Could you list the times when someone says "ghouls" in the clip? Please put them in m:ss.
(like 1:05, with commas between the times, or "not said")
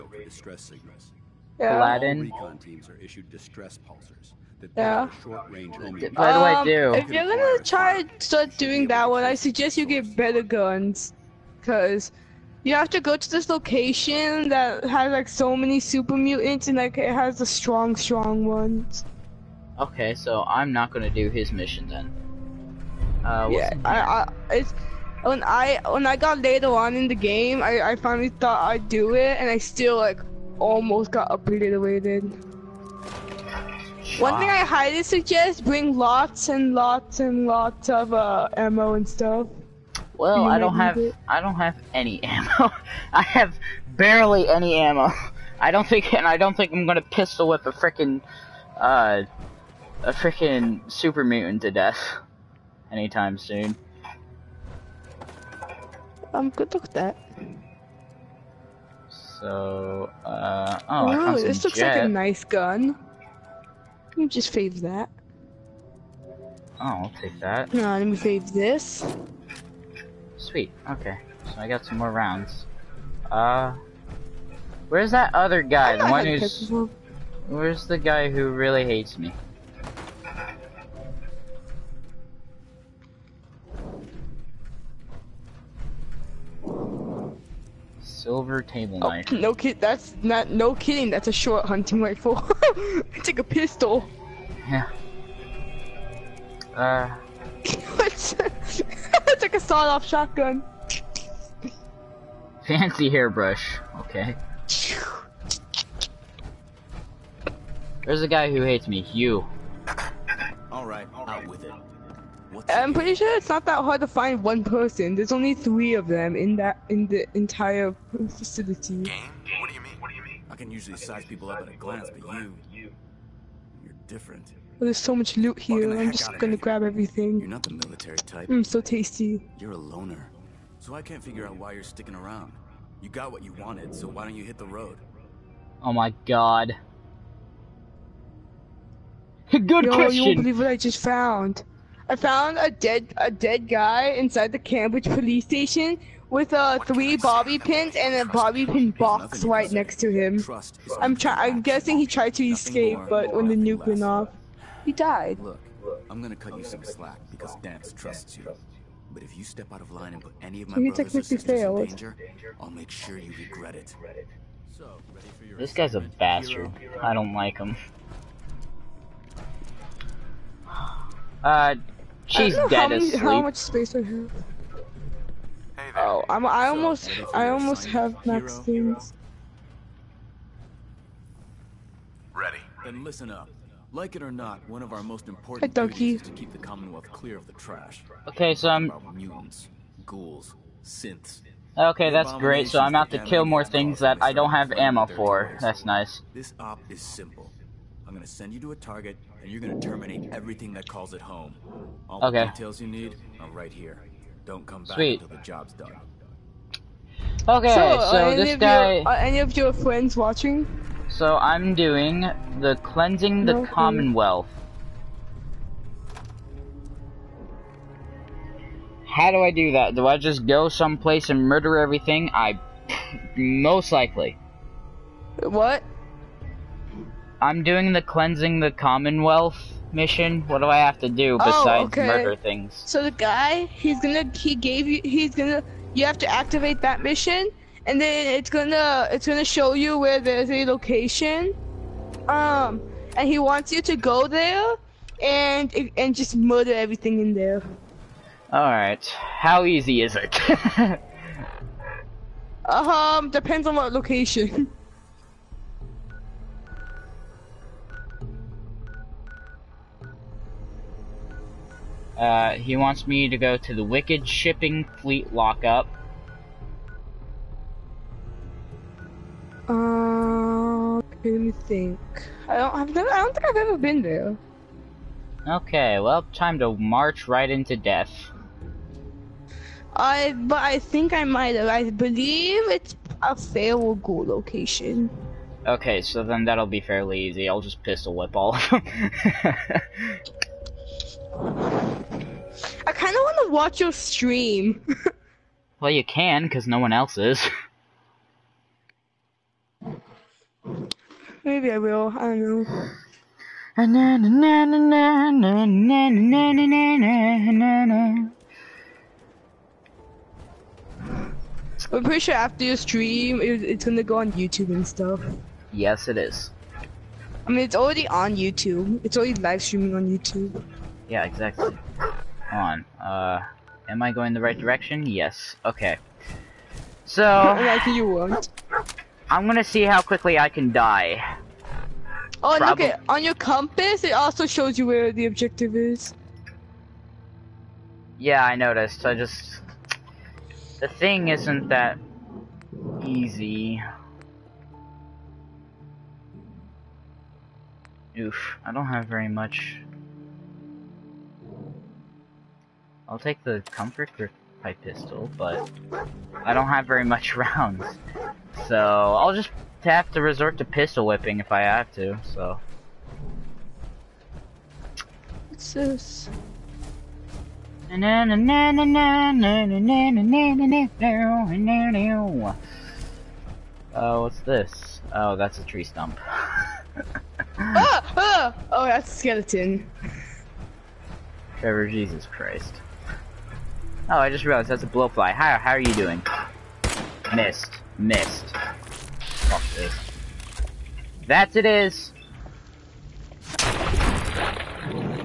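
3:10, 4:43.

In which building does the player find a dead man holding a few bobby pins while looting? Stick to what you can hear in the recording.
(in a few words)
Cambridge police station.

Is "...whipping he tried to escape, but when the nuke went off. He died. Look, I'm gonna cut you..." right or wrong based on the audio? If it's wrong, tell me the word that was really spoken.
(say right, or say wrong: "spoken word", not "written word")
wrong: "guessing", not "whipping".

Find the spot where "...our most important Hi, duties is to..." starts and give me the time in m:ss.
3:04.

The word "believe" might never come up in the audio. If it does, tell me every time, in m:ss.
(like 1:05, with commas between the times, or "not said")
2:20, 4:41.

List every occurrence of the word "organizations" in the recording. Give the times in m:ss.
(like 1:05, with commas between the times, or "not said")
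not said.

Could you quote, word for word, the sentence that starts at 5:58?
So I'll just have to resort to pistol whipping if I have to, so.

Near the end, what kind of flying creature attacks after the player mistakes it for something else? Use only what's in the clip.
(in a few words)
Bloatfly.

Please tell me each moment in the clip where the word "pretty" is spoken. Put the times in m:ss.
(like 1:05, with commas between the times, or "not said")
1:52, 5:12.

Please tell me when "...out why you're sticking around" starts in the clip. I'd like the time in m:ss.
2:11.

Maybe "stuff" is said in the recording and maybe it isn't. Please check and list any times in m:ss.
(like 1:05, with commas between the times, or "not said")
0:39, 5:14.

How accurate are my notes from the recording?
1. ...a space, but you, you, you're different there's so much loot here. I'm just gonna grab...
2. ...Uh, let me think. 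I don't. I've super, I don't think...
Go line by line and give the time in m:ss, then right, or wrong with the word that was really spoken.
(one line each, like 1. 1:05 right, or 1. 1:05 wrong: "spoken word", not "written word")
1. 2:01 wrong: "glance", not "space"
2. 4:29 wrong: "never", not "super".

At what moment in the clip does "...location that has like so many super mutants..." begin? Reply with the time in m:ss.
0:13.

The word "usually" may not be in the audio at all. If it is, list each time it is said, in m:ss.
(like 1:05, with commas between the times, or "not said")
2:00.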